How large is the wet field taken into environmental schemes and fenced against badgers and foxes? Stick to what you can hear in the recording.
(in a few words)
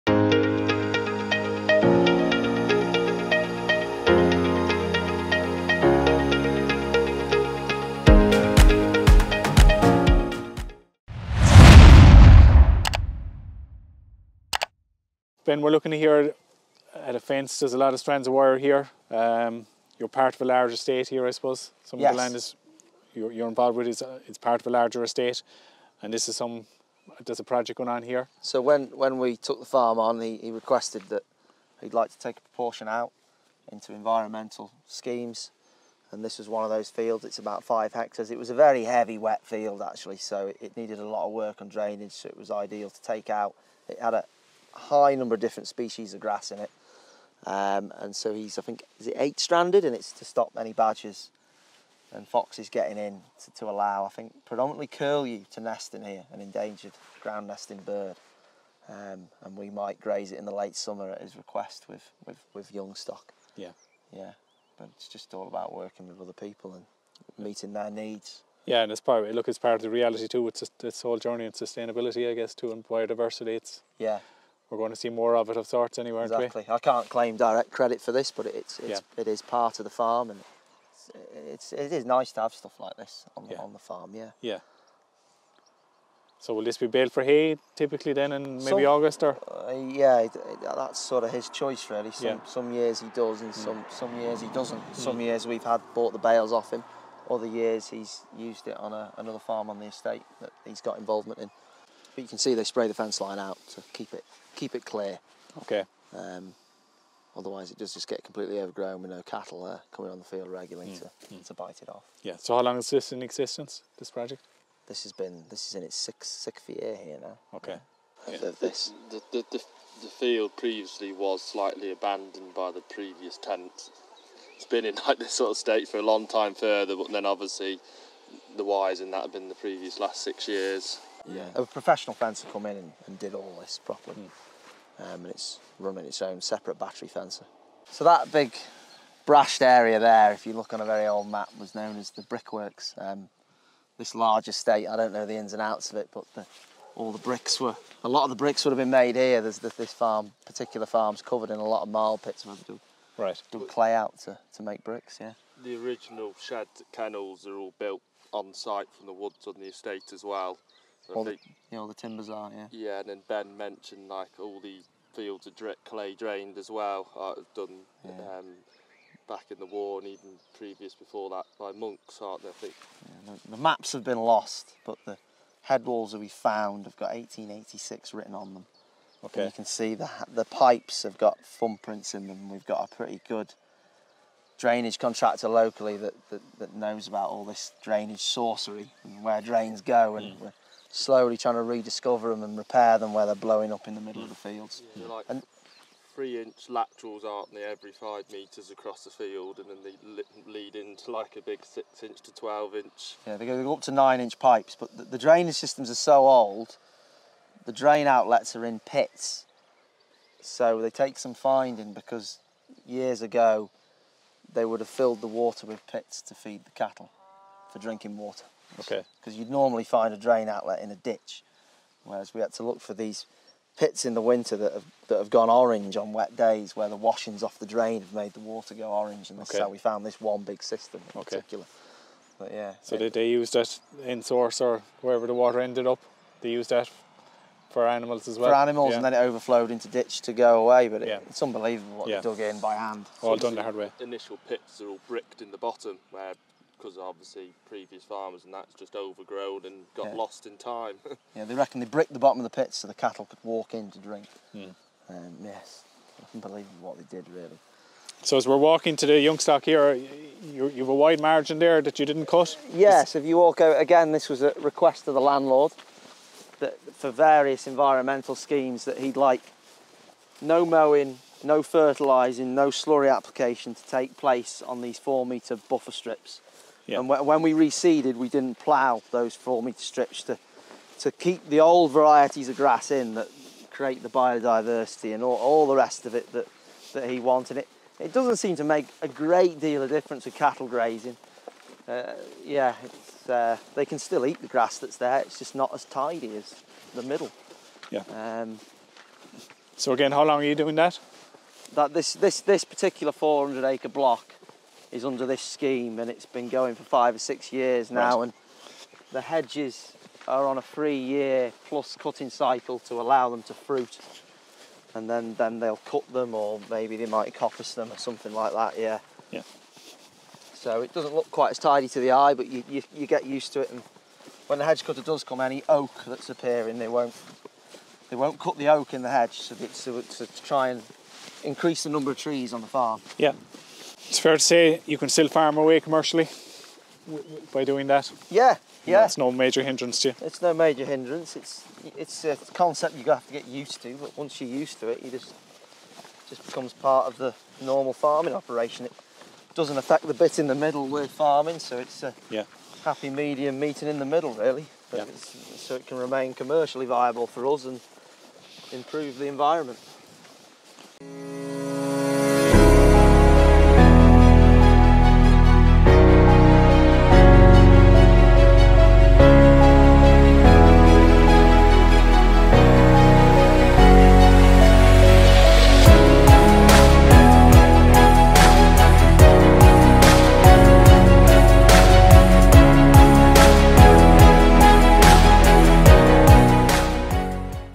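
5 hectares.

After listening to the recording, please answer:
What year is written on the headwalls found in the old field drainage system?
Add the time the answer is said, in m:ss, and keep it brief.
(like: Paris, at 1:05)
1886, at 2:57.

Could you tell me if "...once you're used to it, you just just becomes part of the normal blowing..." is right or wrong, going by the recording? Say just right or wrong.
wrong.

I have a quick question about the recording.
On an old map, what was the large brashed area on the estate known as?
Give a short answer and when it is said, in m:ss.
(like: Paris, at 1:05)
the brickworks, at 2:22.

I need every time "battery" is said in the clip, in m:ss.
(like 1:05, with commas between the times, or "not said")
2:16.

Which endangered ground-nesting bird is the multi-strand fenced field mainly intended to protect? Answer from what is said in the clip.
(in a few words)
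curlew.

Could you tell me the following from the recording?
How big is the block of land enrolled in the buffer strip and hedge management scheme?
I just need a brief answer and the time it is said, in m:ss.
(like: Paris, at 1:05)
400 acres, at 5:03.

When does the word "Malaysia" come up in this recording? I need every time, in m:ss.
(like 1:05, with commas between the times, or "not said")
not said.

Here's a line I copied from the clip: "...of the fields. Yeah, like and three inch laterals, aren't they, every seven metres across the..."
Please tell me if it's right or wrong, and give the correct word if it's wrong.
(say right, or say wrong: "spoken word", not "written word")
wrong: "five", not "seven".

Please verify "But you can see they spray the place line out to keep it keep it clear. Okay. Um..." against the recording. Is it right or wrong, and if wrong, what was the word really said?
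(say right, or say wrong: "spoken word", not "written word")
wrong: "fence", not "place".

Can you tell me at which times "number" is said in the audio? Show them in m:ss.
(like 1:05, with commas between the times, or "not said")
0:45, 5:31.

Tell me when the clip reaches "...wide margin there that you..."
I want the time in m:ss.
4:20.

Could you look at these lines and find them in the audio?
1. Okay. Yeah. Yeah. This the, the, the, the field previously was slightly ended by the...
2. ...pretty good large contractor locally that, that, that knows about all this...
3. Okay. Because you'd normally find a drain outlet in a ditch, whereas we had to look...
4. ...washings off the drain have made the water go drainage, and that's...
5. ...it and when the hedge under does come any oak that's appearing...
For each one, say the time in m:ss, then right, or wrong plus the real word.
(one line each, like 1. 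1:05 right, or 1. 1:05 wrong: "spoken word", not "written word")
1. 1:57 wrong: "abandoned", not "ended"
2. 3:02 wrong: "drainage", not "large"
3. 3:38 right
4. 3:46 wrong: "orange", not "drainage"
5. 5:23 wrong: "cutter", not "under".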